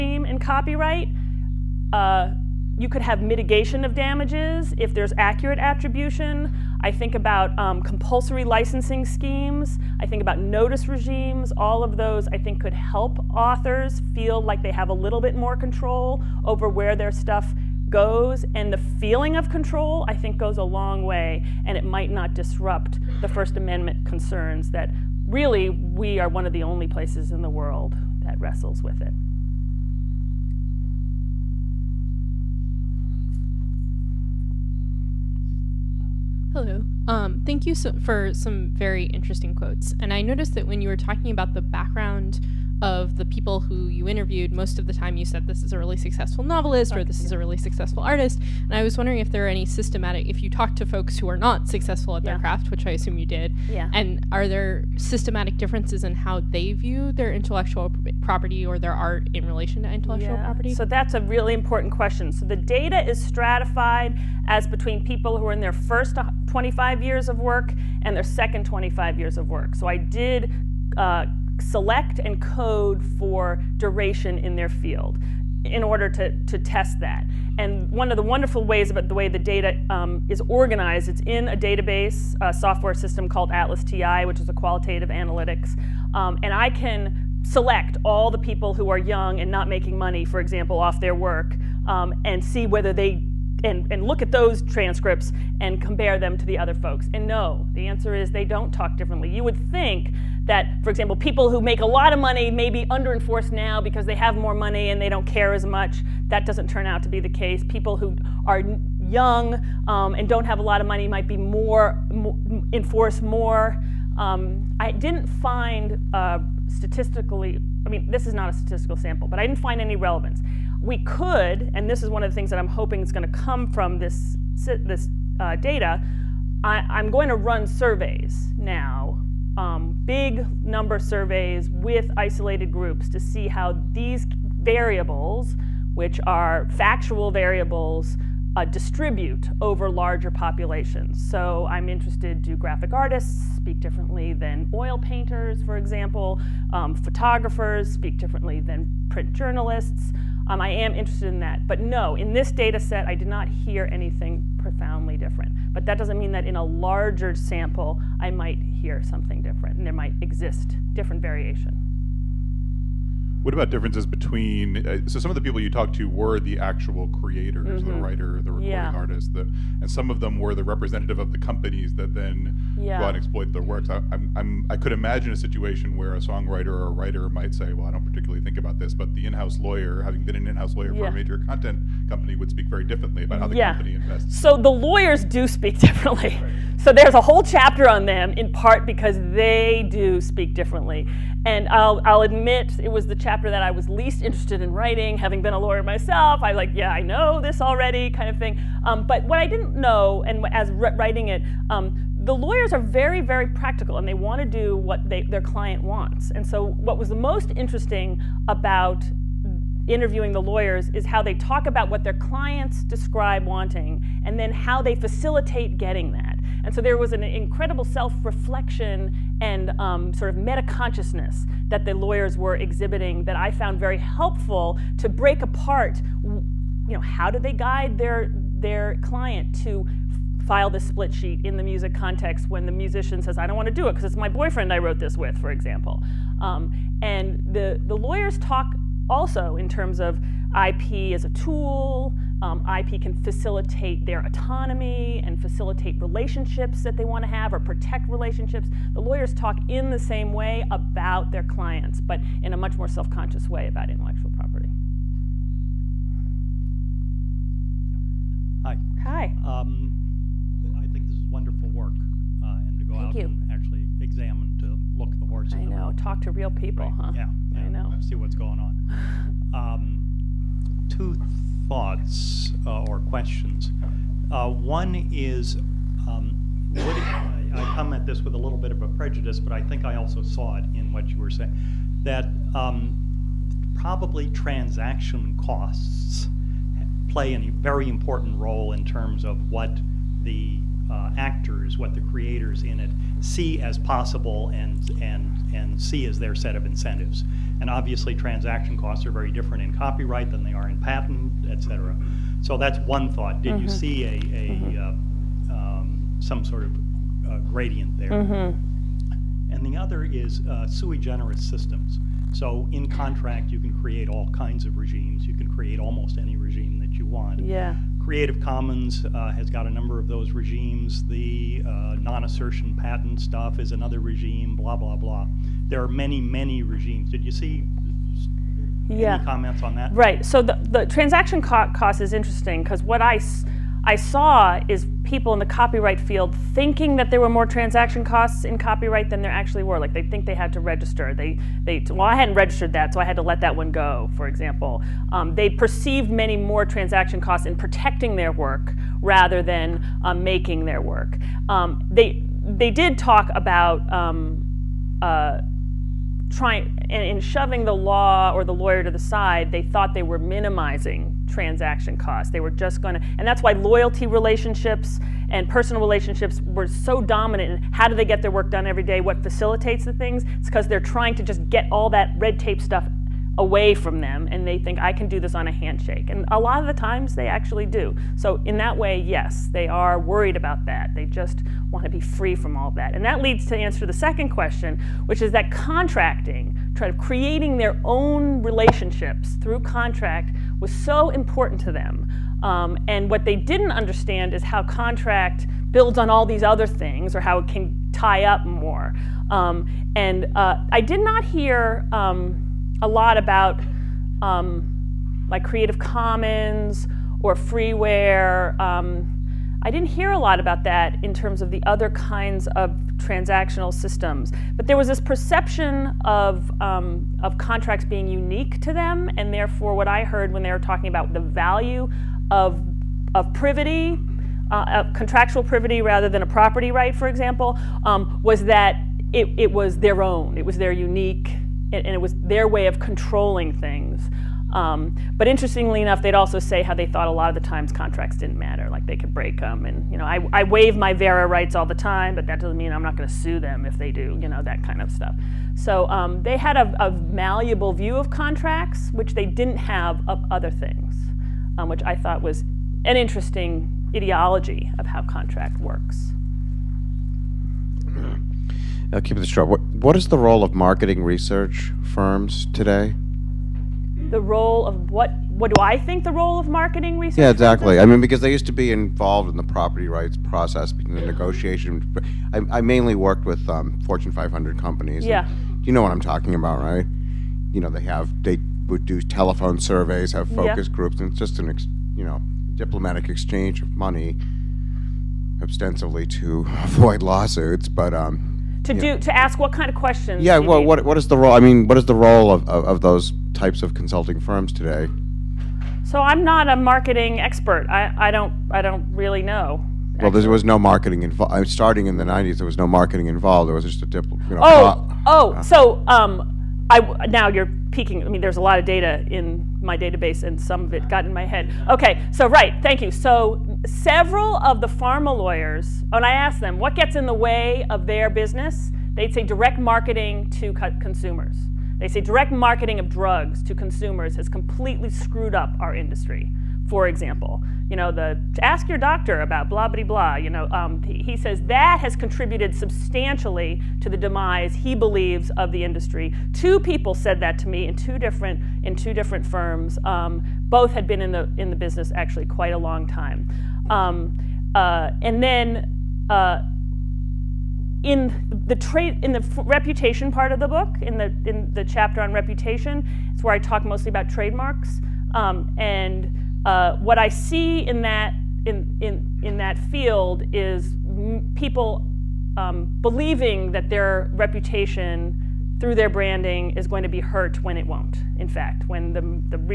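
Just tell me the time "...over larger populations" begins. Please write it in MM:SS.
02:19.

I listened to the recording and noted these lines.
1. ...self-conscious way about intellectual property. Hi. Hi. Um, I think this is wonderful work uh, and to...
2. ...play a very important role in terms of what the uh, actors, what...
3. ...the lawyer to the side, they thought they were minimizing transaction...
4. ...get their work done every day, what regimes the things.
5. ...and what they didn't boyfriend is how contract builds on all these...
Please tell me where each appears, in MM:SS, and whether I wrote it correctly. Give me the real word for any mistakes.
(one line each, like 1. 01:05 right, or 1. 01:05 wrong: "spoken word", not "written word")
1. 04:12 right
2. 04:47 right
3. 05:58 right
4. 06:08 wrong: "facilitates", not "regimes"
5. 06:32 wrong: "understand", not "boyfriend".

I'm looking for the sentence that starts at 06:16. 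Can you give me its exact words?
And a lot of the times they actually do.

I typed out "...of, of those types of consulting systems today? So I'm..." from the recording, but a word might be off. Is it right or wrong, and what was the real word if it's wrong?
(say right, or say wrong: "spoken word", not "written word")
wrong: "firms", not "systems".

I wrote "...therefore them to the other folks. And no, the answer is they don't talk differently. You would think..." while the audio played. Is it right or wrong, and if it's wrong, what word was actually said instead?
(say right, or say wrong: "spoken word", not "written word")
wrong: "compare", not "therefore".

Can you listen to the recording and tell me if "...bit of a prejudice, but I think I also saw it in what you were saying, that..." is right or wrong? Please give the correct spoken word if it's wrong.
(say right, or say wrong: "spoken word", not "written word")
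right.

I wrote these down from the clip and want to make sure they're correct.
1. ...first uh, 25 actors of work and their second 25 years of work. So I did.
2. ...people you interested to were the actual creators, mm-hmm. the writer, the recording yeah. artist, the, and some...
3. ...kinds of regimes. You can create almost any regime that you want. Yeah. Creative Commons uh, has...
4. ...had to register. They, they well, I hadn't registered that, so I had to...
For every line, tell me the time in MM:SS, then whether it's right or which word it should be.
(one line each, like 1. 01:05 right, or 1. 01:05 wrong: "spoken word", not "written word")
1. 01:05 wrong: "years", not "actors"
2. 02:45 wrong: "talked", not "interested"
3. 05:14 right
4. 05:40 right.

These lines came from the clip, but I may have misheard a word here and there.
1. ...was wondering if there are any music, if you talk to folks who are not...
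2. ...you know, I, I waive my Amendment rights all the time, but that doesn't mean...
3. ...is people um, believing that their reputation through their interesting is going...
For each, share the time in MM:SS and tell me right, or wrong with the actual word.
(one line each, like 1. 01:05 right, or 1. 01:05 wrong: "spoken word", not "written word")
1. 00:48 wrong: "systematic", not "music"
2. 07:19 wrong: "Vera", not "Amendment"
3. 09:20 wrong: "branding", not "interesting".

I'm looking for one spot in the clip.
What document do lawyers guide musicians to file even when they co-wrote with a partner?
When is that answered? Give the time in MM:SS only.
03:50.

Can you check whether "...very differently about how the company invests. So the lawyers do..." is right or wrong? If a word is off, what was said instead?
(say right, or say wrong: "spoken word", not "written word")
right.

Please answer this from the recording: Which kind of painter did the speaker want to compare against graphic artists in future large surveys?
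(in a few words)
oil painters.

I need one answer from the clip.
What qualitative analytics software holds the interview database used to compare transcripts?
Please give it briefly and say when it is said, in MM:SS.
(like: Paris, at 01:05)
ATLAS.ti, at 01:23.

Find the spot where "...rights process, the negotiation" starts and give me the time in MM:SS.
07:49.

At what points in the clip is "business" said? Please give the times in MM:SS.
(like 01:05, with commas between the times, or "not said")
08:38, 09:01.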